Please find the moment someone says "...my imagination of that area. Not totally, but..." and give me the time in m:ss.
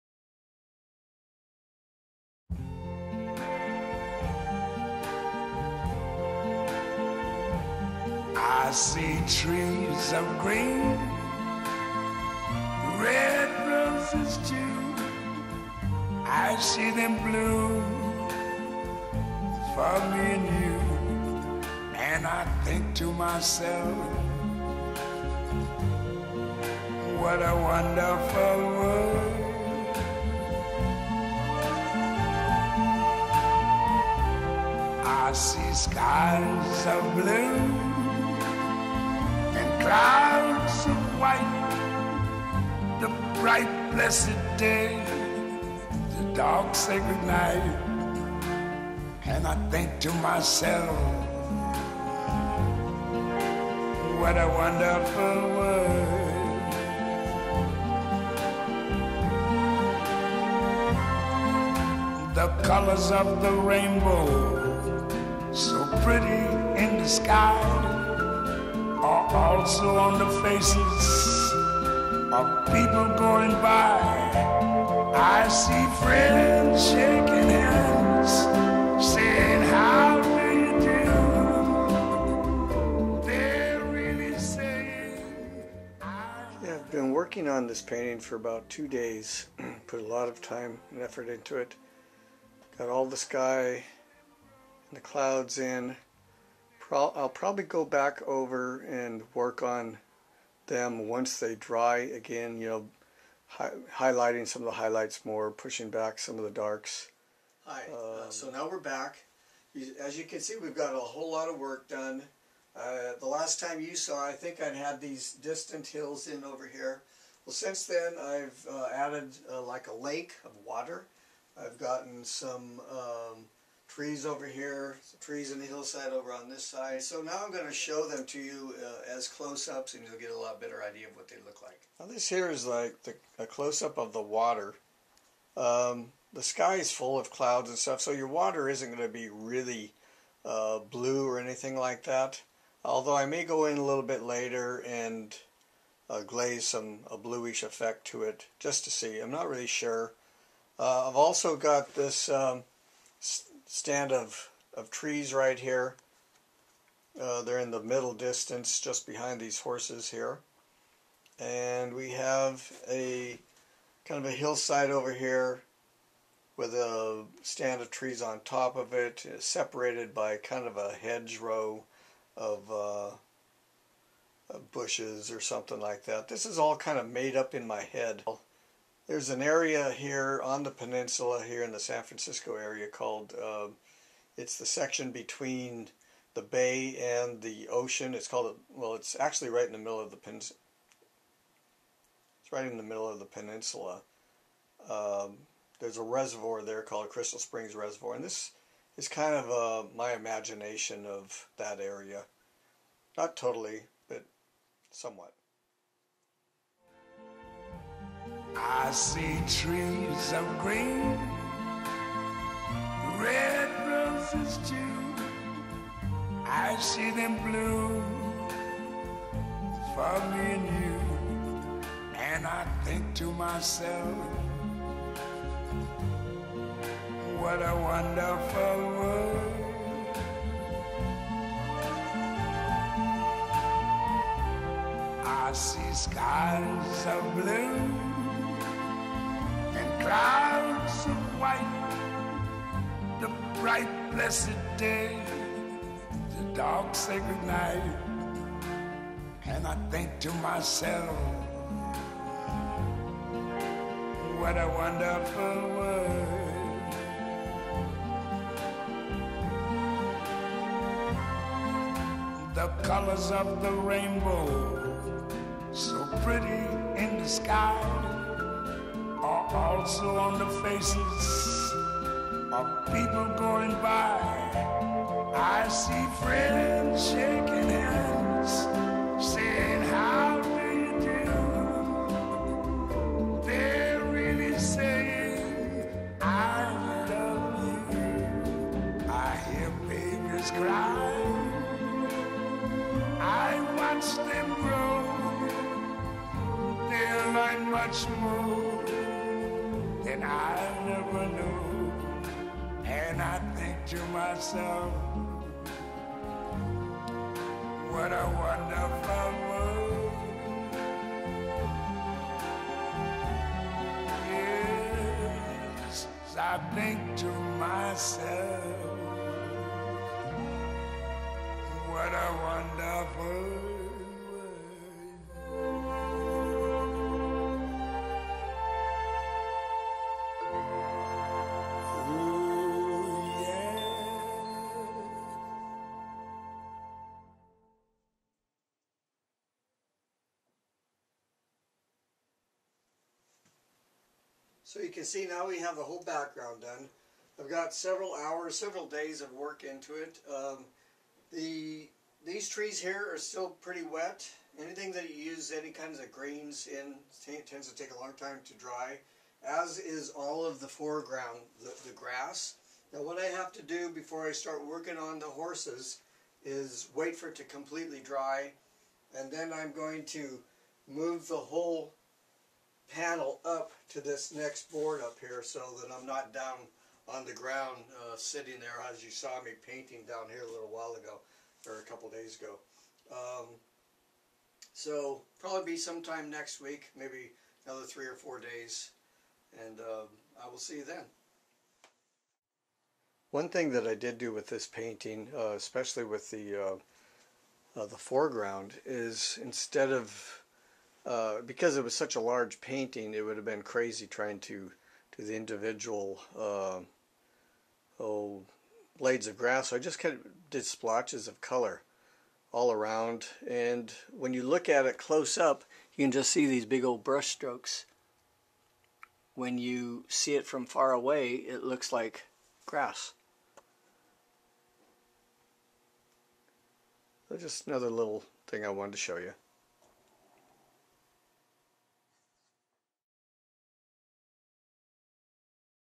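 3:19.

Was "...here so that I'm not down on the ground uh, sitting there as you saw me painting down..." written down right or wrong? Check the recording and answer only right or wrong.
right.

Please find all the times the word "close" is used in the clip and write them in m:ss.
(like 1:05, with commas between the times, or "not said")
2:09, 2:13, 6:54.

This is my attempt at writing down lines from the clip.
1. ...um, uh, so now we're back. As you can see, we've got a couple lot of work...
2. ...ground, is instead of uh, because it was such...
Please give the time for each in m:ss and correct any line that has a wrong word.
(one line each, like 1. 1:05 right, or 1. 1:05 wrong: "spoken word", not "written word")
1. 1:47 wrong: "whole", not "couple"
2. 6:37 wrong: "foreground", not "ground".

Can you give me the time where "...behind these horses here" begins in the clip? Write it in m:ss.
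2:39.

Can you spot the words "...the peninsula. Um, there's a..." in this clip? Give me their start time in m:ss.
3:13.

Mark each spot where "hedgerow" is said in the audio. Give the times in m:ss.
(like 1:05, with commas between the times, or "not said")
2:51.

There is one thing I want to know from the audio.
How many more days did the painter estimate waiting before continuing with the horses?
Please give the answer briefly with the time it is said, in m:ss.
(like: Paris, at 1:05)
3 or 4 days, at 6:27.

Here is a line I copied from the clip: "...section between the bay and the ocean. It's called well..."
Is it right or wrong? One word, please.
right.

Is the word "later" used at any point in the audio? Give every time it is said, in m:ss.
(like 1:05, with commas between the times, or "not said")
2:24.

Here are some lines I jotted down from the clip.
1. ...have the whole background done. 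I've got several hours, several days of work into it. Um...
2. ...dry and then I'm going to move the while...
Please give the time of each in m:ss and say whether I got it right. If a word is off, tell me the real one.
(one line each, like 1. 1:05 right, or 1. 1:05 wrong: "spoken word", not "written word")
1. 5:45 right
2. 6:07 wrong: "whole", not "while".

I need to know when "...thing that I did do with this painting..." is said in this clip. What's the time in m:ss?
6:33.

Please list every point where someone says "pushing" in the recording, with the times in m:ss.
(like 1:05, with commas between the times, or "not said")
1:45.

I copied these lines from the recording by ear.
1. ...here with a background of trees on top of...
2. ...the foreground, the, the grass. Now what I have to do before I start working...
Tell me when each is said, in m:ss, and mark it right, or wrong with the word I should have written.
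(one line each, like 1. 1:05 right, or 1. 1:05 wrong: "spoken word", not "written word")
1. 2:45 wrong: "stand", not "background"
2. 6:00 right.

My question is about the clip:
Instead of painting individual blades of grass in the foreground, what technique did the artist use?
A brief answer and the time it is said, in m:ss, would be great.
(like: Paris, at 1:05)
Splotches of color, at 6:50.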